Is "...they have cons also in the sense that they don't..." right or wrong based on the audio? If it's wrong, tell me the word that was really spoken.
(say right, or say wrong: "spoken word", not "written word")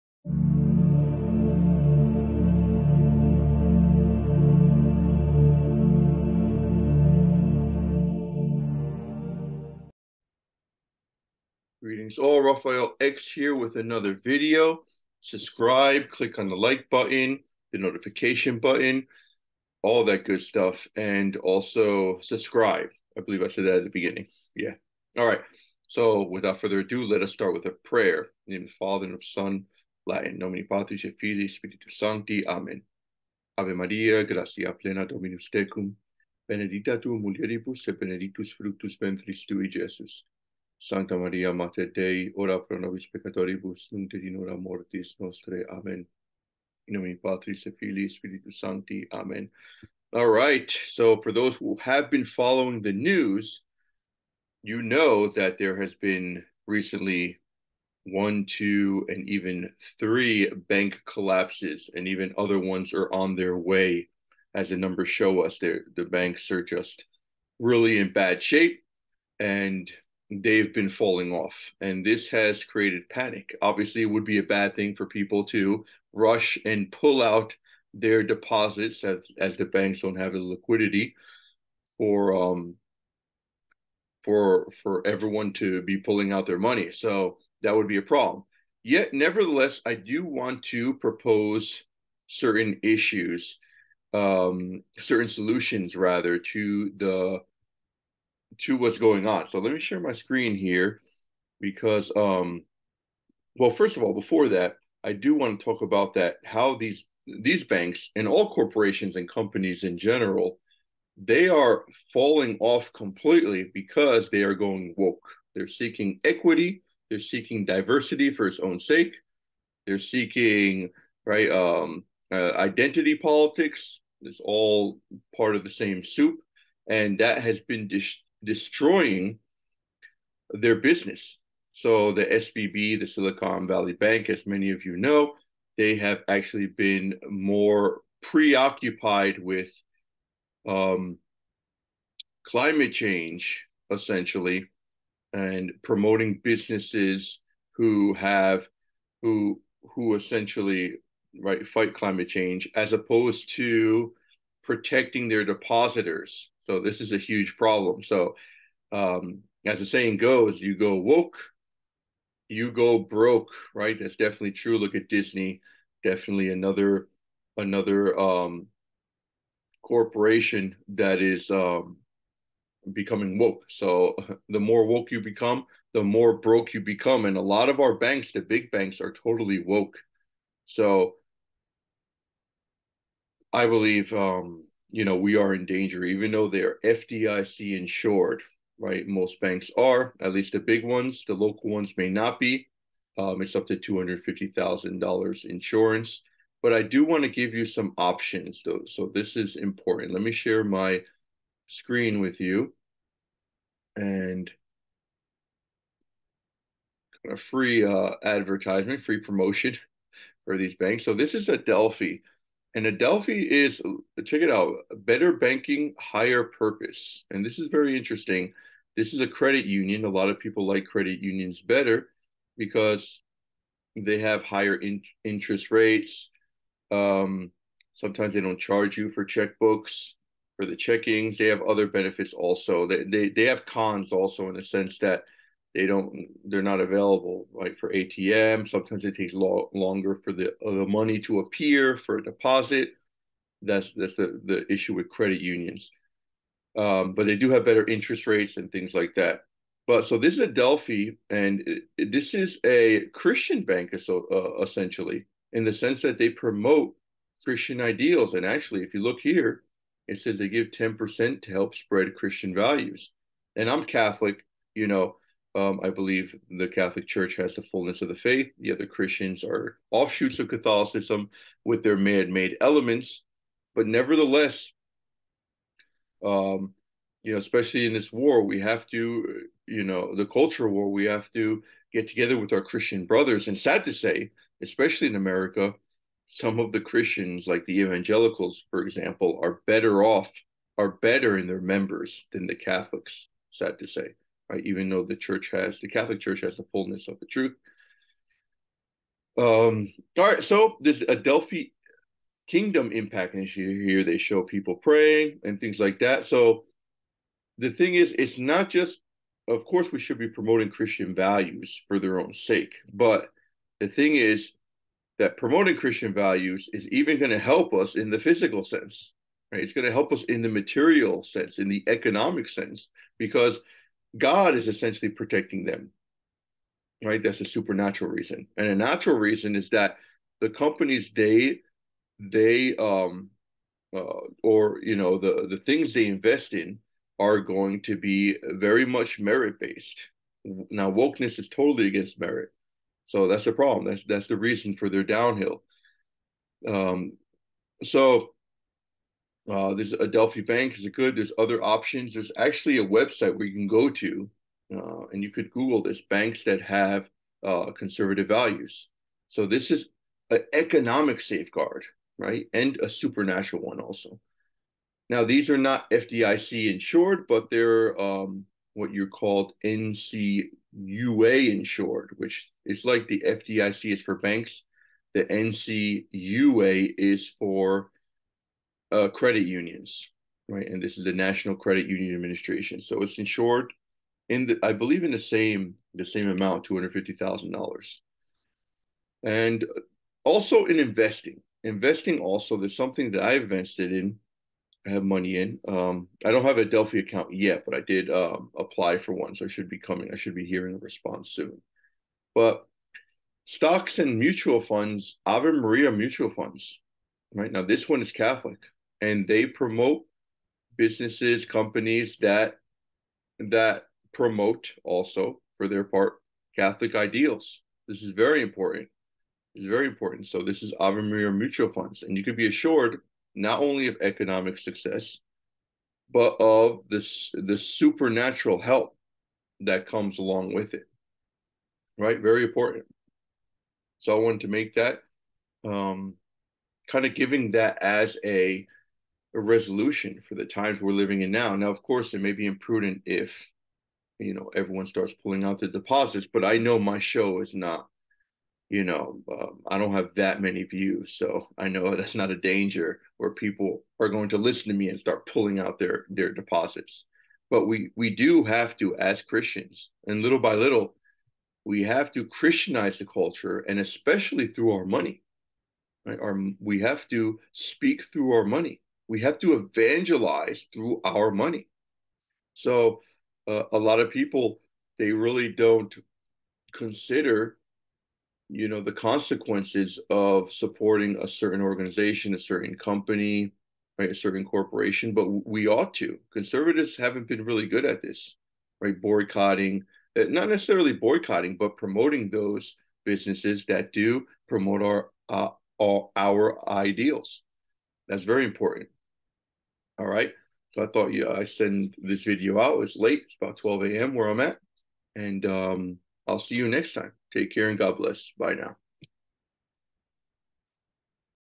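right.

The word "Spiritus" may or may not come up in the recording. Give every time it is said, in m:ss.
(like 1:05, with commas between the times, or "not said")
0:31, 0:48.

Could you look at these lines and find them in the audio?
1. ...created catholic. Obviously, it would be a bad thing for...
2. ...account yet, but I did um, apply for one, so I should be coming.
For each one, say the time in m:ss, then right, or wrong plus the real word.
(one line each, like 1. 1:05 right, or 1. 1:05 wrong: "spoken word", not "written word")
1. 1:12 wrong: "panic", not "catholic"
2. 6:37 right.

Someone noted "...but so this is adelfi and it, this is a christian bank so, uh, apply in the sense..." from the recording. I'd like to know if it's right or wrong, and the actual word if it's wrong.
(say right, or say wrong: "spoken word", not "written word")
wrong: "essentially", not "apply".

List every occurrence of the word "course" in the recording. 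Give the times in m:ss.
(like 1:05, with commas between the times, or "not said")
5:09, 7:21.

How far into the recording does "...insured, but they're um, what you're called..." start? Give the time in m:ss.
6:06.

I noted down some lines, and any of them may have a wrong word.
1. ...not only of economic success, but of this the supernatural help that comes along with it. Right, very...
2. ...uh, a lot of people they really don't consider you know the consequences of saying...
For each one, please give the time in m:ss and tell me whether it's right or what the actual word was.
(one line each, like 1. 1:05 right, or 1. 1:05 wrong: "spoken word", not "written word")
1. 7:03 right
2. 7:53 wrong: "supporting", not "saying".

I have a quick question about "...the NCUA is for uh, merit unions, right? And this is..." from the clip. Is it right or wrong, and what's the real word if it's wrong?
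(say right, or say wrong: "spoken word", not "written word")
wrong: "credit", not "merit".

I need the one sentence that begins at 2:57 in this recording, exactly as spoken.
And a lot of our banks, the big banks, are totally woke.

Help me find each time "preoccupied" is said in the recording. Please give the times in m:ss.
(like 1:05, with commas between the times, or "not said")
2:18.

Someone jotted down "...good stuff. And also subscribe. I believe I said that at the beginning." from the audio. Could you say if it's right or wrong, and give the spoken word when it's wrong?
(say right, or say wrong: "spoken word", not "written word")
right.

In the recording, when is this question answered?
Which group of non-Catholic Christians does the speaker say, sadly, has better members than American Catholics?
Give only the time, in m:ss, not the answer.
4:47.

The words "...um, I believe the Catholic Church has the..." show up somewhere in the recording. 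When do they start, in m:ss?
4:25.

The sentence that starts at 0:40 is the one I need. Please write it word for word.
Sancta Maria, Mater Dei, ora pro nobis peccatoribus, nunc et in hora mortis nostre.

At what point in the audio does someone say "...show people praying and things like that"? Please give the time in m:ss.
5:04.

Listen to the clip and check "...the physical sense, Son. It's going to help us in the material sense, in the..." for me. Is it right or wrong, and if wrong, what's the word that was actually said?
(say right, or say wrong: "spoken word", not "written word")
wrong: "Right", not "Son".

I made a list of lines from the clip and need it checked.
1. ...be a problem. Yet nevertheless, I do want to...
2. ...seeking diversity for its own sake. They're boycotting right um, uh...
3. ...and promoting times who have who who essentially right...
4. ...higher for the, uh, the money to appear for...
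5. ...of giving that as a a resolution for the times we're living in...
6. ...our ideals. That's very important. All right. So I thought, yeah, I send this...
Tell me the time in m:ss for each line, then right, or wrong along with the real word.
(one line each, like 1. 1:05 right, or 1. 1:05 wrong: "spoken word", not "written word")
1. 1:27 right
2. 1:57 wrong: "seeking", not "boycotting"
3. 2:25 wrong: "businesses", not "times"
4. 3:59 wrong: "longer", not "higher"
5. 7:17 right
6. 8:16 right.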